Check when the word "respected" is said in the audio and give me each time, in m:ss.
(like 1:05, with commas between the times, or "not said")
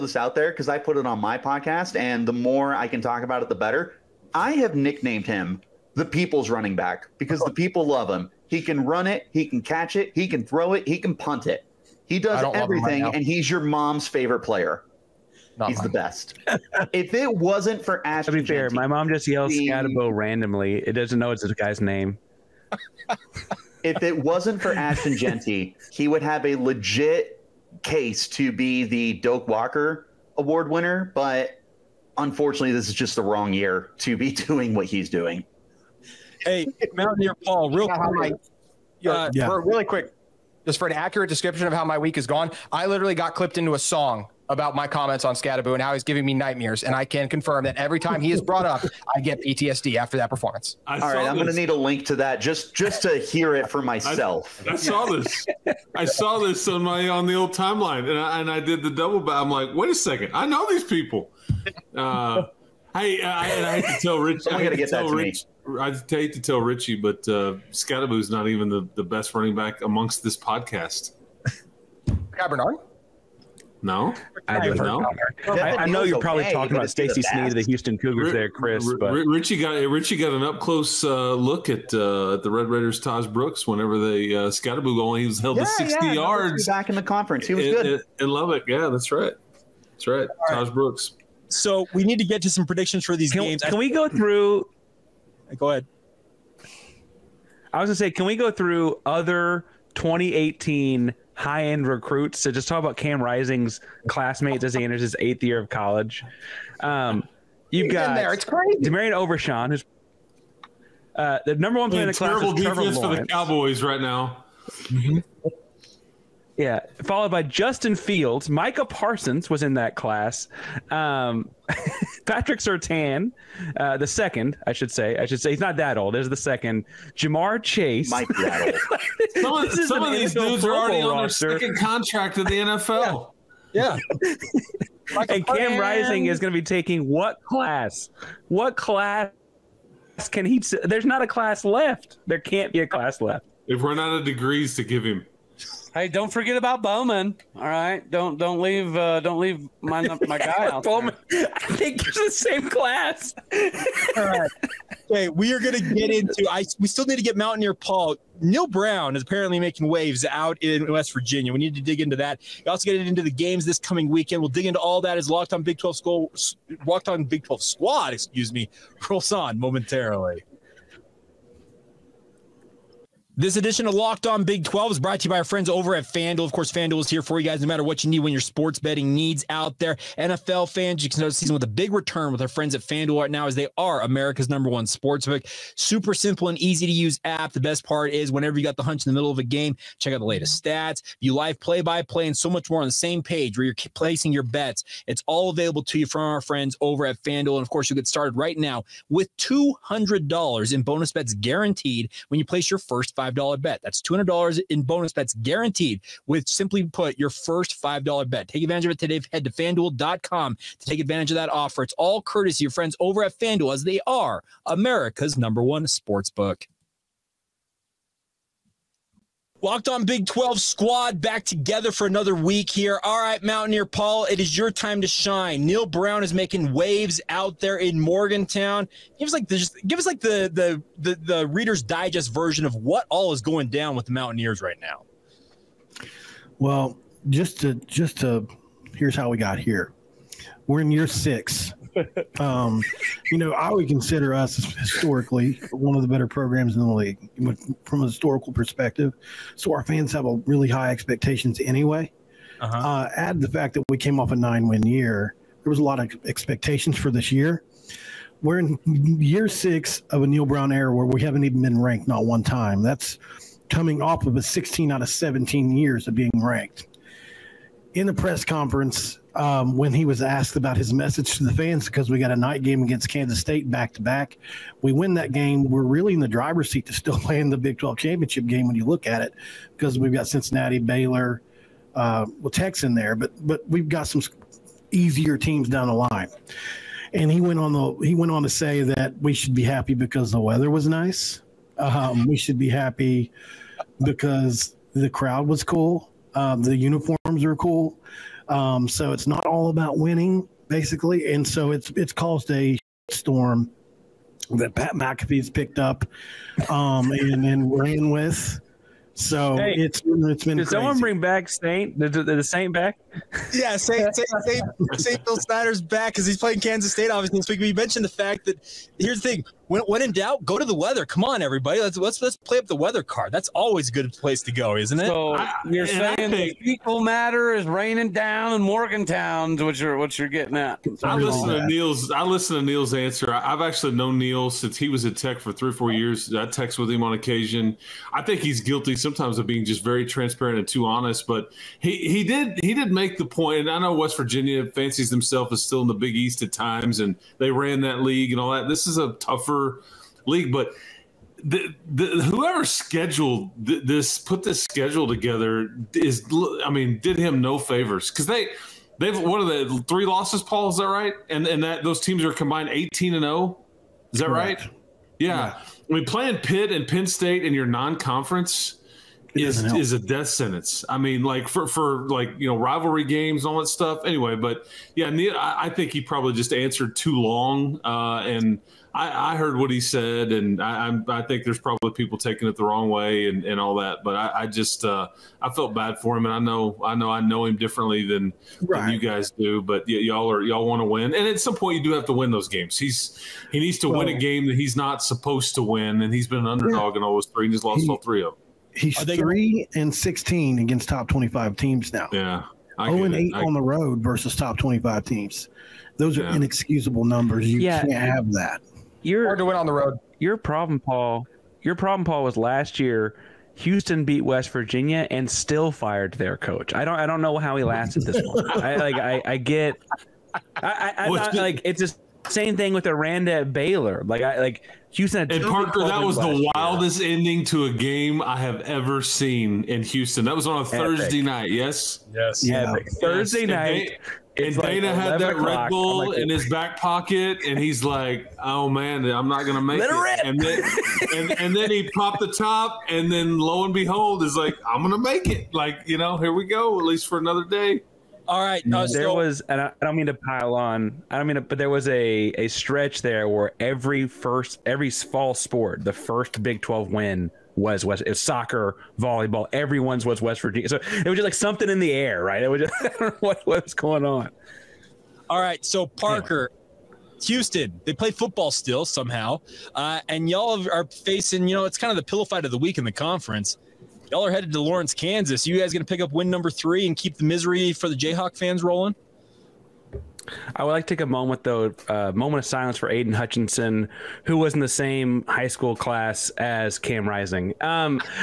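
not said.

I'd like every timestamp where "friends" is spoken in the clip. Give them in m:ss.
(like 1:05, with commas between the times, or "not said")
2:55, 3:02, 3:16, 3:32.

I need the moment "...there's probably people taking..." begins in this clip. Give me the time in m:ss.
6:21.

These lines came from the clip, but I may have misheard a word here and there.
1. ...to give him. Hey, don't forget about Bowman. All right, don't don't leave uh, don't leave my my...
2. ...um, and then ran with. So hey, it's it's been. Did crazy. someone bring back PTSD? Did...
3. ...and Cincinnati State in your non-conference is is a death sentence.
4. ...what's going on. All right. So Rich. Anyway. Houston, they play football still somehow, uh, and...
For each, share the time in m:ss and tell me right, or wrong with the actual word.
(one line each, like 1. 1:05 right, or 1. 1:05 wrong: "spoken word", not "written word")
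1. 2:24 right
2. 5:06 wrong: "Saint", not "PTSD"
3. 6:06 wrong: "Penn", not "Cincinnati"
4. 7:43 wrong: "Parker", not "Rich".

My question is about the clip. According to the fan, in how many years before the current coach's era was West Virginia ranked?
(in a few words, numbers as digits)
17.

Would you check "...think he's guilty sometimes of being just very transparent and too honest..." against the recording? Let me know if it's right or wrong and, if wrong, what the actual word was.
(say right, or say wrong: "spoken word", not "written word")
right.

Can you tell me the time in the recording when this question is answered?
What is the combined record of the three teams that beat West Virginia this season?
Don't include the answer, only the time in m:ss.
6:02.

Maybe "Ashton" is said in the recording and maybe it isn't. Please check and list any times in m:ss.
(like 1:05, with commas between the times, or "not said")
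0:18, 0:24.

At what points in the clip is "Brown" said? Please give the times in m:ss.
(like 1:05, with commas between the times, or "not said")
2:38, 3:45, 4:20.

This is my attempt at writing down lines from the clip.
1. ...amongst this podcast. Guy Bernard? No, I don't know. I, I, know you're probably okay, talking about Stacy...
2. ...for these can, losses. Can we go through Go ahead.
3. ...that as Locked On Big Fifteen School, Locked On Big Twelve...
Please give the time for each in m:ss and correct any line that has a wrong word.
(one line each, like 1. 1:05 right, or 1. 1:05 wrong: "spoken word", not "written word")
1. 1:09 right
2. 1:33 wrong: "games", not "losses"
3. 2:45 wrong: "Twelve", not "Fifteen".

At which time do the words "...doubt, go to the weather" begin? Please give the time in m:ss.
5:20.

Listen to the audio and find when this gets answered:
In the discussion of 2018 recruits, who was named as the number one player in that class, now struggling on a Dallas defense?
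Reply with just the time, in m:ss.
1:48.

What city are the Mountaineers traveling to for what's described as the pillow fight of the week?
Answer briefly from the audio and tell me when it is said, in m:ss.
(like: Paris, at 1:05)
Lawrence, Kansas, at 7:54.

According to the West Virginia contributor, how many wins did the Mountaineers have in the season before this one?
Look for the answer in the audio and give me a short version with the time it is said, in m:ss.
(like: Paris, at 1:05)
9, at 4:14.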